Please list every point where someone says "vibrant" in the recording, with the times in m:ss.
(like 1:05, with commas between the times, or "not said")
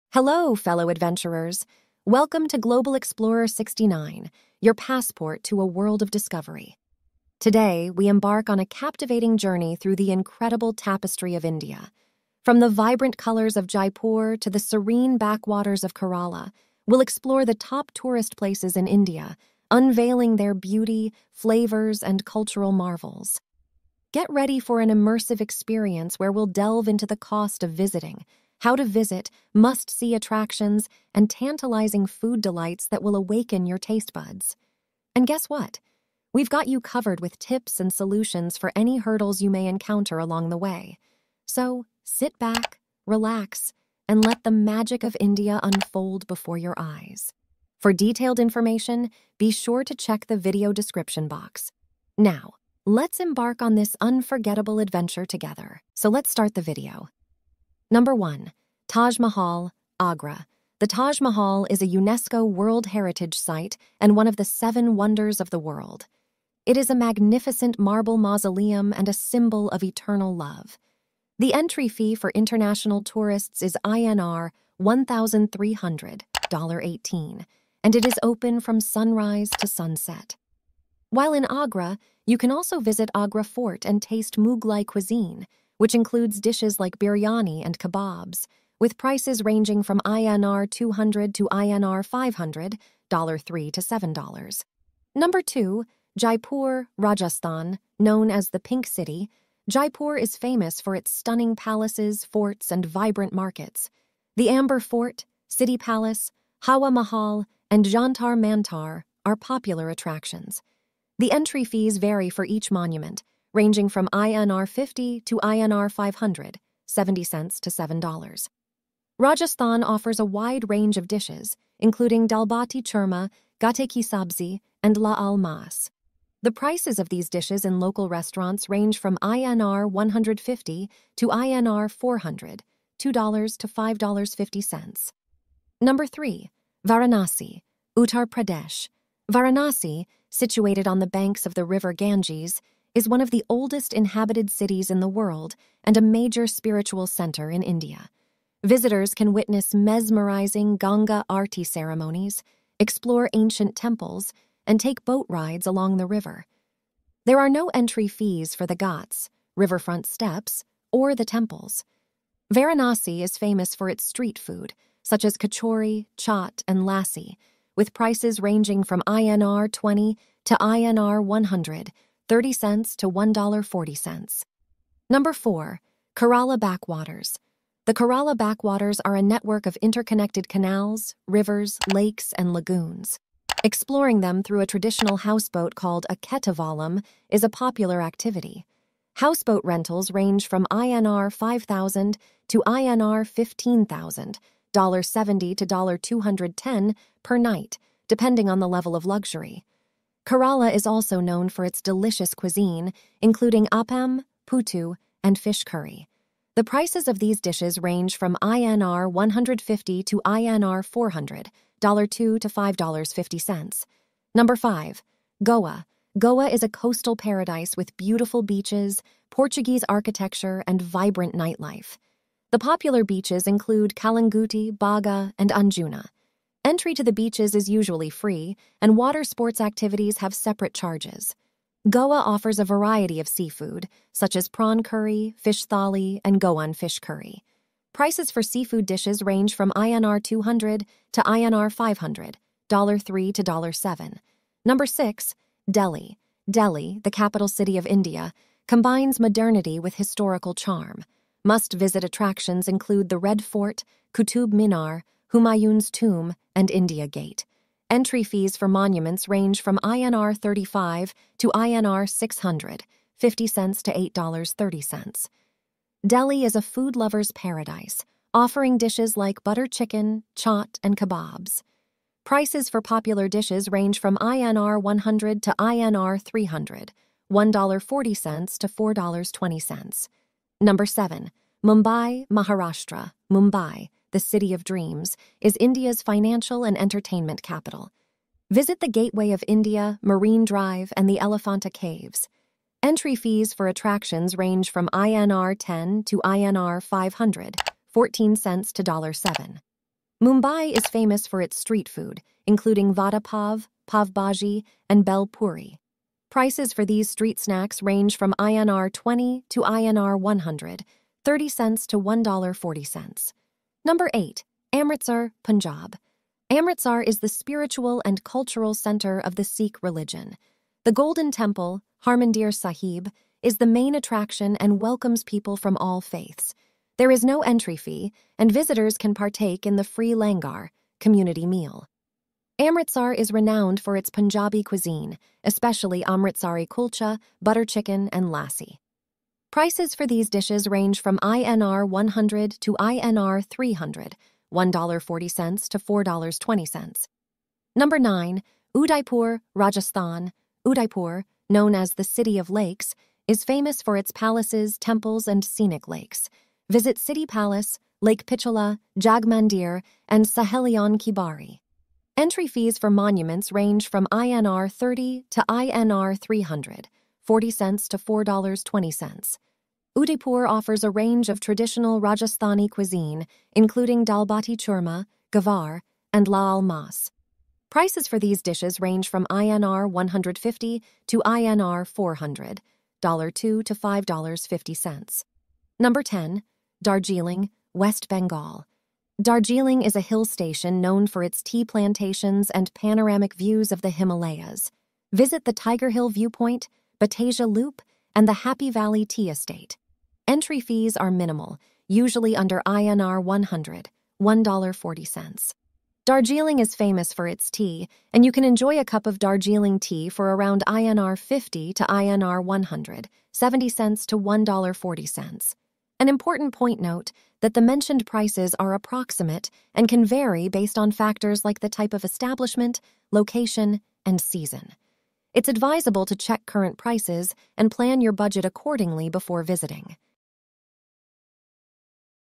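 0:12, 1:42, 3:40.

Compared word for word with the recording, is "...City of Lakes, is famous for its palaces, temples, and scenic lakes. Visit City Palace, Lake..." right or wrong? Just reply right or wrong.
right.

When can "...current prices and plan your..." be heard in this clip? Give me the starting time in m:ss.
7:06.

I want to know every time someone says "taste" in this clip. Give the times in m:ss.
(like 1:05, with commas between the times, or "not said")
0:33, 1:24.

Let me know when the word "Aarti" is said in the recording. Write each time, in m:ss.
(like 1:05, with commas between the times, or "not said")
2:31.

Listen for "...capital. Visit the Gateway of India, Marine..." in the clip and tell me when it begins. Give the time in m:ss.
4:47.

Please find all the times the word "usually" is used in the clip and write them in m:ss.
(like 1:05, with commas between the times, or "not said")
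3:47, 6:41.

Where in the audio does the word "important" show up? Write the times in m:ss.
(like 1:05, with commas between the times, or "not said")
6:56.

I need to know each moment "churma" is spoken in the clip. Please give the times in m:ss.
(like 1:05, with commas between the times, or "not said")
2:02, 6:14.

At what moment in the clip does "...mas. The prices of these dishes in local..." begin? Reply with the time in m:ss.
2:05.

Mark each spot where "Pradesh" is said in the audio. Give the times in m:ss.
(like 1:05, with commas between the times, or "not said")
2:18.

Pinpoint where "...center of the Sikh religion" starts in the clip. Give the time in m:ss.
5:18.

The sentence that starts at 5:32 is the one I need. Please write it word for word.
Amritsar is renowned for its Punjabi cuisine, especially Amritsari kulcha, butter chicken, and lassi.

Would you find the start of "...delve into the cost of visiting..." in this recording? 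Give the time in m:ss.
0:26.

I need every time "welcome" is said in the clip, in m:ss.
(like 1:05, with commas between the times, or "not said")
0:02, 5:24.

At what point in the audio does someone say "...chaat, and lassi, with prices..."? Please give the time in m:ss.
2:46.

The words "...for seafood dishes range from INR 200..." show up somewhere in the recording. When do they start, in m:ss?
3:58.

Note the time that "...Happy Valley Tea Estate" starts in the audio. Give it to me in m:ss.
6:38.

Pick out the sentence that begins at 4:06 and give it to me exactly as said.
Delhi, the capital city of India, combines modernity with historical charm.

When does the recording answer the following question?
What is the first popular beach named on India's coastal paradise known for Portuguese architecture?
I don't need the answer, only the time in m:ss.
3:43.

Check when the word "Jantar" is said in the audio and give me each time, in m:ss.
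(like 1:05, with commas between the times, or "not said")
1:47.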